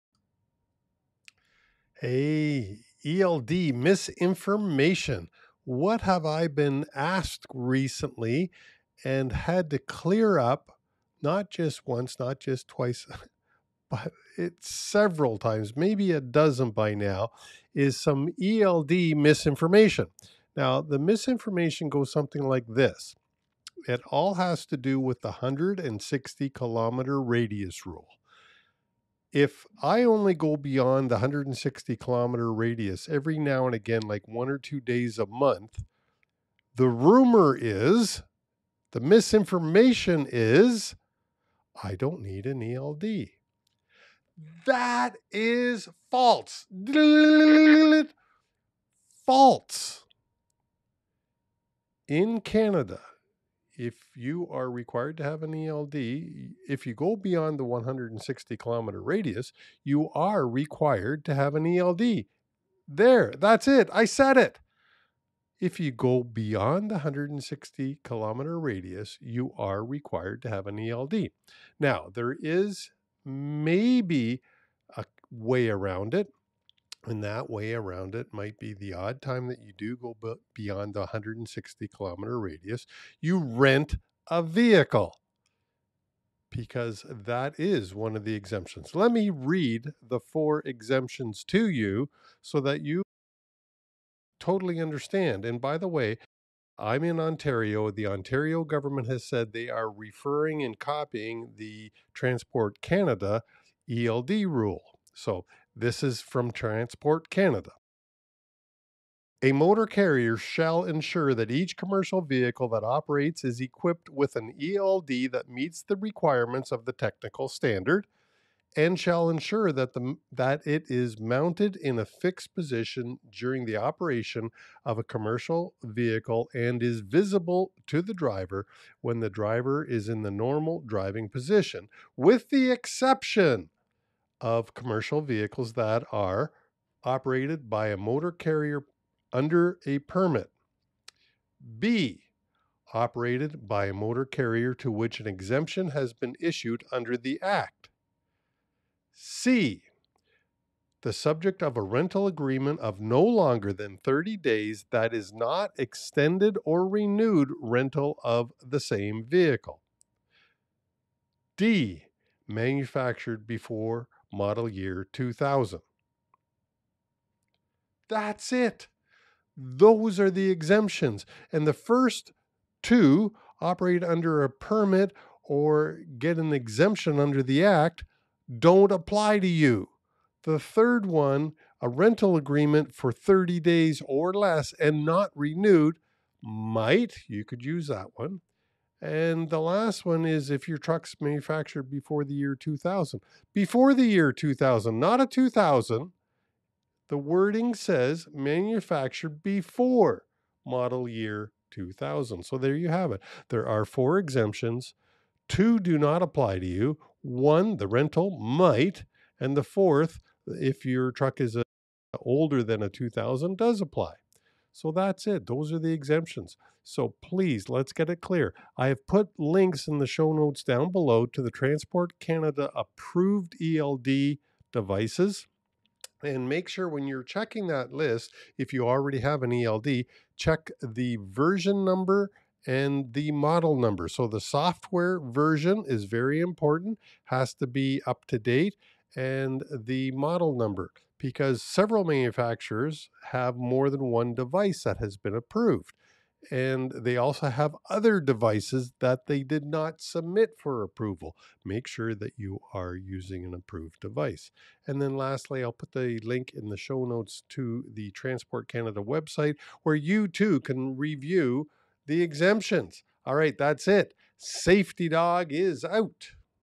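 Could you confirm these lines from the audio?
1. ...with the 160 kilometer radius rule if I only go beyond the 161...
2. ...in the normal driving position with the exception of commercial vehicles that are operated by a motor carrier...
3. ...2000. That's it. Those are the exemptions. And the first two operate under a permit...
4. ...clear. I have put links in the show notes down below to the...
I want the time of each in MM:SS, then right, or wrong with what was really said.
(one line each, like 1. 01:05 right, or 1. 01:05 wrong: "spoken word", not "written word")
1. 00:24 wrong: "160", not "161"
2. 02:10 right
3. 02:45 right
4. 03:38 right.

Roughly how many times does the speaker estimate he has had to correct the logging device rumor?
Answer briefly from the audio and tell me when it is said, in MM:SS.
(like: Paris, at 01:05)
a dozen, at 00:15.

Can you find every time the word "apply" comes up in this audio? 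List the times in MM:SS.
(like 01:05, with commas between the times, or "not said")
02:58, 03:26, 03:33.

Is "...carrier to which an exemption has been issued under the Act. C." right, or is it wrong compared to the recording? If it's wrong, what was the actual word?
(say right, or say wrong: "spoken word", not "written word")
right.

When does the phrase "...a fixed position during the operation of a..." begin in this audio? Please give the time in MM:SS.
02:01.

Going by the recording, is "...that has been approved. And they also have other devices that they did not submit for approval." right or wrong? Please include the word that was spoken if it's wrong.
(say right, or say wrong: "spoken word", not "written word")
right.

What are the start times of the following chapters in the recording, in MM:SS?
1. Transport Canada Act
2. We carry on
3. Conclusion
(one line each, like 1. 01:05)
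1. 01:49
2. 02:45
3. 04:10.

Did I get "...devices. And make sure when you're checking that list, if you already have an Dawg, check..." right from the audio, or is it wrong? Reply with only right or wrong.
wrong.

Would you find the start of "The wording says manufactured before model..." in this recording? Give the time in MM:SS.
03:17.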